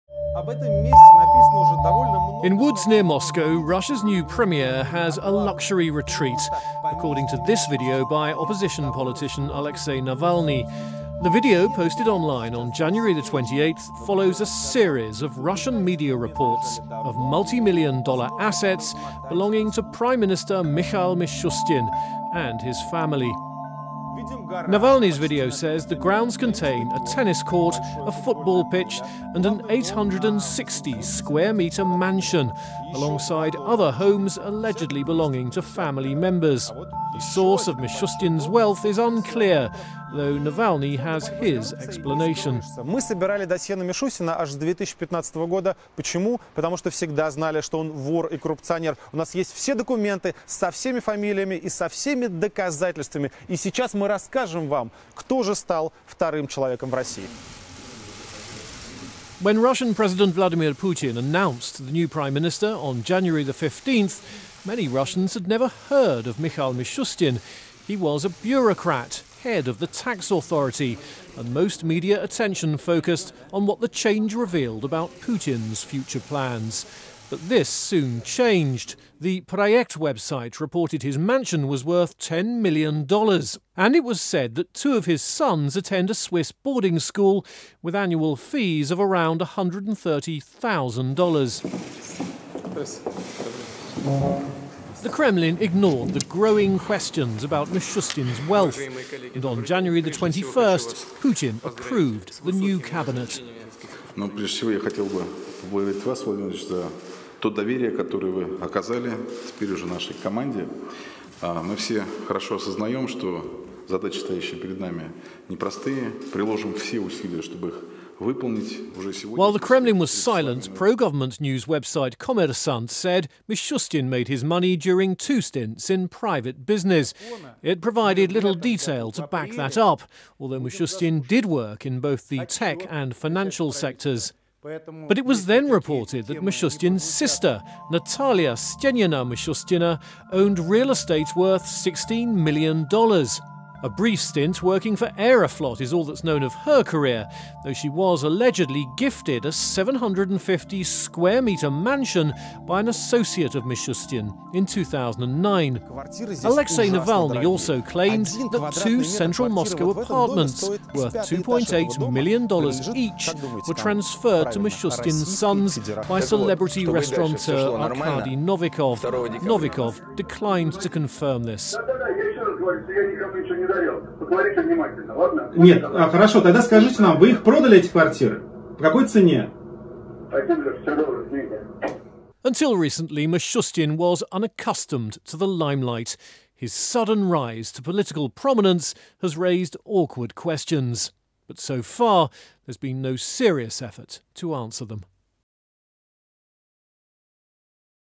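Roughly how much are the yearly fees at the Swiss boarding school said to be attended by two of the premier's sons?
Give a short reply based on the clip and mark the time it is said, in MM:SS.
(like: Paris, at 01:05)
$130,000, at 01:28.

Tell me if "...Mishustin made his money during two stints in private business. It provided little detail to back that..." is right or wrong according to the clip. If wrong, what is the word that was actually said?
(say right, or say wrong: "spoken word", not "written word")
right.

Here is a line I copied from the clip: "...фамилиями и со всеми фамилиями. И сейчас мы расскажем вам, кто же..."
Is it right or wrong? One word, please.
wrong.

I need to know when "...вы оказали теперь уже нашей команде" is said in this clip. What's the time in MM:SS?
01:48.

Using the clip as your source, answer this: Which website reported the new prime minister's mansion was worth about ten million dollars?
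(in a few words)
The Project.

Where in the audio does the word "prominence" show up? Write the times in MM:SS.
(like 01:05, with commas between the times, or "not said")
03:08.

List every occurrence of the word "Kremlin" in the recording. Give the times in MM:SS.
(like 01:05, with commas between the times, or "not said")
01:35, 01:59.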